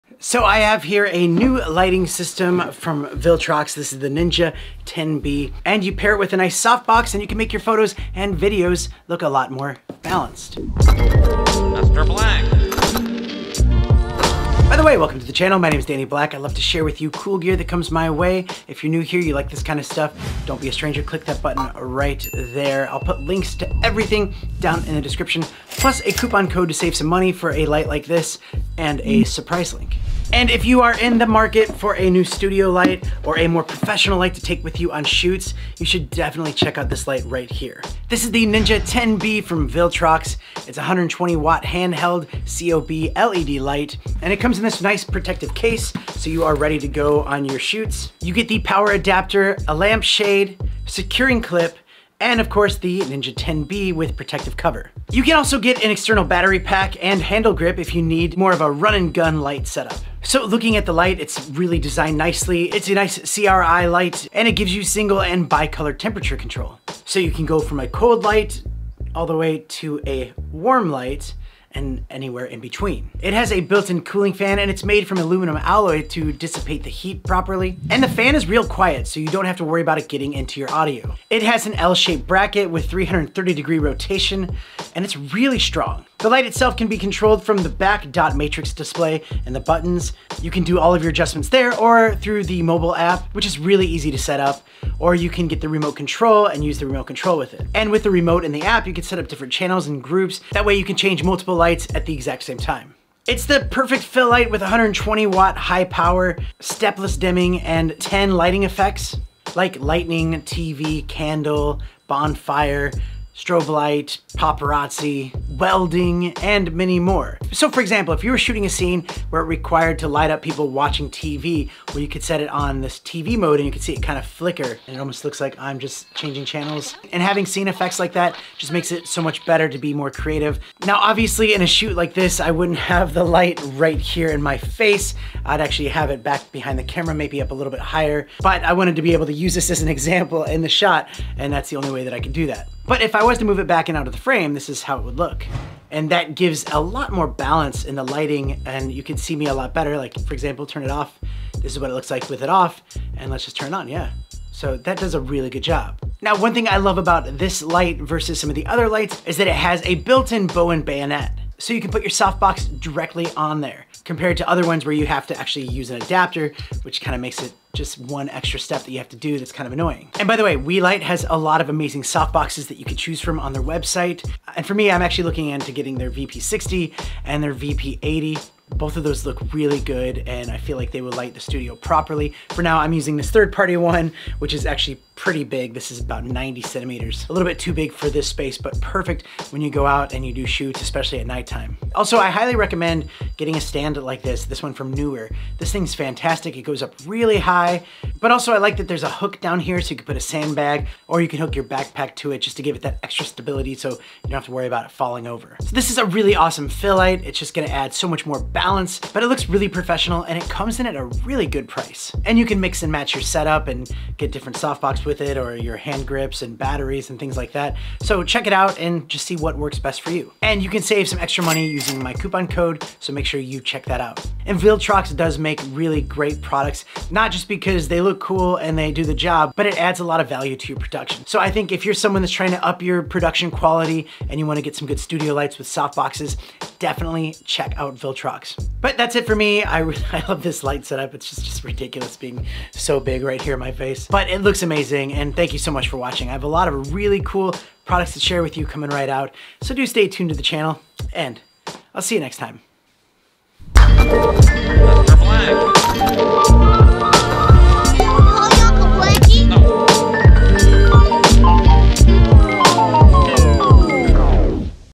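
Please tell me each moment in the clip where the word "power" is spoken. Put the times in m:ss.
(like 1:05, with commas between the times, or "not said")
0:48, 1:45.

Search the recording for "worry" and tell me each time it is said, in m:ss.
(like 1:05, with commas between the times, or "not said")
1:19, 3:24.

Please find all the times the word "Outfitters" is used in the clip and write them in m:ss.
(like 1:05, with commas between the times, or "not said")
not said.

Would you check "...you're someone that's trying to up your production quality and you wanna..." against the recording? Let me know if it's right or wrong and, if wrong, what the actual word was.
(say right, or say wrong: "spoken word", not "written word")
right.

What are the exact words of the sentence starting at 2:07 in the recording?
And having scene effects like that just makes it so much better to be more creative.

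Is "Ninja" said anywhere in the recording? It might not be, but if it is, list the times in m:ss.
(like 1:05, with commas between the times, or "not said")
0:04, 0:38, 0:53.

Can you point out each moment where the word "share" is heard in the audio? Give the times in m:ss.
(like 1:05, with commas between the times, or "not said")
0:16, 4:08.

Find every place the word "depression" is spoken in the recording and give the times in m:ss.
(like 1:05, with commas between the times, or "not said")
not said.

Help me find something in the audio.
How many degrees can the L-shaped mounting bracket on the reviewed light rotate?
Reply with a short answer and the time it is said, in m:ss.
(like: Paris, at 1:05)
330 degrees, at 1:22.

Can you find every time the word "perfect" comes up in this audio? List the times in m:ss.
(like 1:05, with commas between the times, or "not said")
1:43, 3:08.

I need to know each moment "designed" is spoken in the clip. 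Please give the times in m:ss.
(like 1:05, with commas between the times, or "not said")
1:01.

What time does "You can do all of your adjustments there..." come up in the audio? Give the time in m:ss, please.
1:30.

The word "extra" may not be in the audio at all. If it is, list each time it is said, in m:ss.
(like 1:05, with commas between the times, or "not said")
2:48, 3:23, 3:41.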